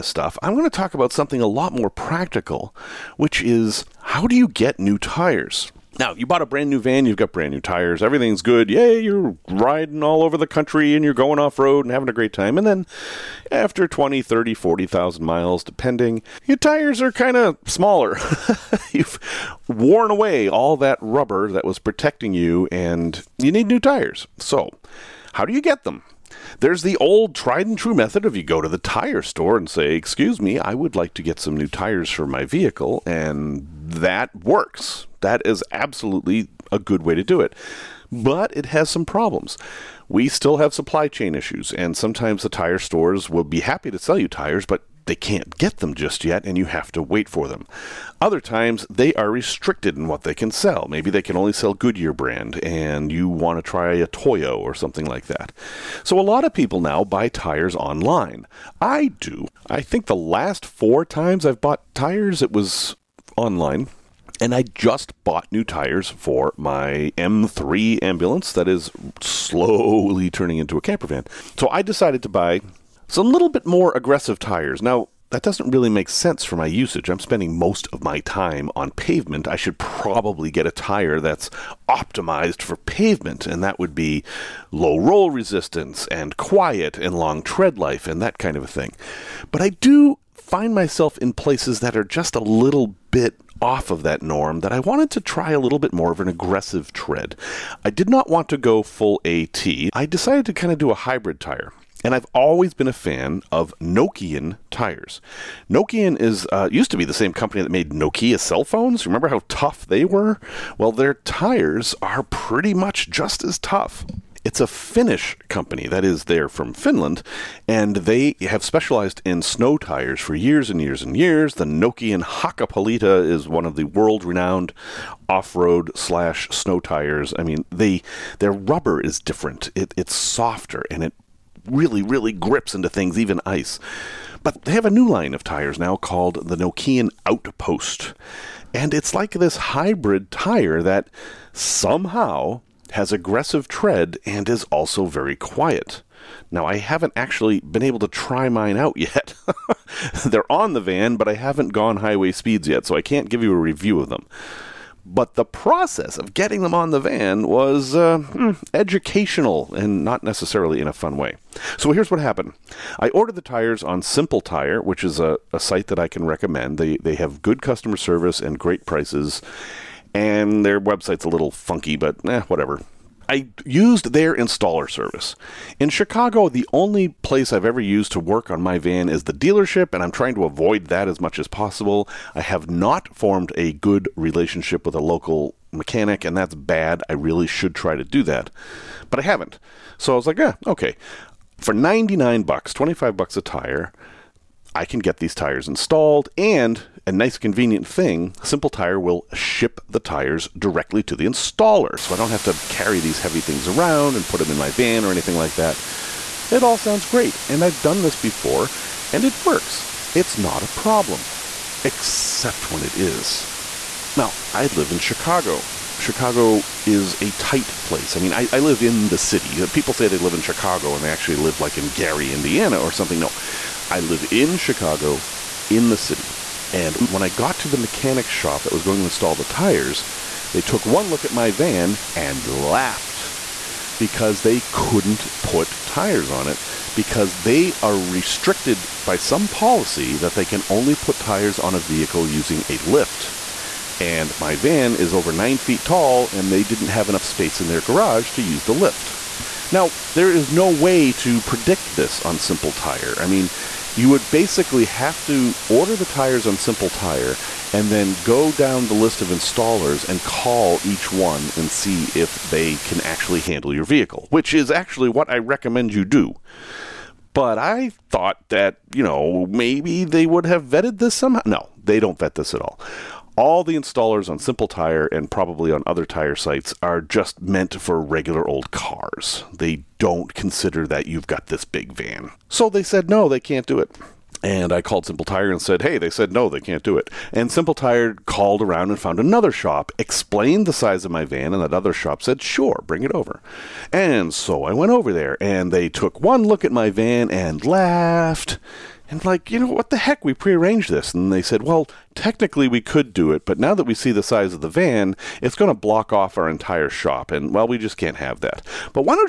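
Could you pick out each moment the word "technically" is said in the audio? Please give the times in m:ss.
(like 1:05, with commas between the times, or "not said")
5:02.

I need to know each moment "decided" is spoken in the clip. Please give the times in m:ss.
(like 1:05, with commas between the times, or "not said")
1:11, 1:40.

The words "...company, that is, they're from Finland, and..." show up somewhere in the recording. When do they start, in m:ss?
1:55.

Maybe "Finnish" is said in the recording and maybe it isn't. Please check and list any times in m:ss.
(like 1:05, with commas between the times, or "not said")
1:54.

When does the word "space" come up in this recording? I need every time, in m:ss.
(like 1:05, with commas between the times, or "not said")
4:07.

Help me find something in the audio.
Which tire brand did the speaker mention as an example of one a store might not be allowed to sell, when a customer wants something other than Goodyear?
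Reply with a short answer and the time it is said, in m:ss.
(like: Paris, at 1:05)
Toyo, at 0:54.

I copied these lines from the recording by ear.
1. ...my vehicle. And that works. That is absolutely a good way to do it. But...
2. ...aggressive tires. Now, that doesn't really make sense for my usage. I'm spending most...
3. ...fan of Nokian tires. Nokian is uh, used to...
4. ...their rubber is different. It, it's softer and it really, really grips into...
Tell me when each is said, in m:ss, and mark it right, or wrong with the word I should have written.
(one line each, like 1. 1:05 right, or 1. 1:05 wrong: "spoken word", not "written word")
1. 0:32 right
2. 1:13 right
3. 1:42 right
4. 2:08 right.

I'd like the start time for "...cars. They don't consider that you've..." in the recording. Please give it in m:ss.
4:38.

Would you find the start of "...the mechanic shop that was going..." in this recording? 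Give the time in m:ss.
3:47.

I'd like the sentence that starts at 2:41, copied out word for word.
So here's what happened I ordered the tires on Simple Tire, which is a, a site that I can recommend.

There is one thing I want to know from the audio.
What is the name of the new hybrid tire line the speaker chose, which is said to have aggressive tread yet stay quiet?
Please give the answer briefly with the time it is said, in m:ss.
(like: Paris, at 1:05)
Nokian Outpost, at 2:16.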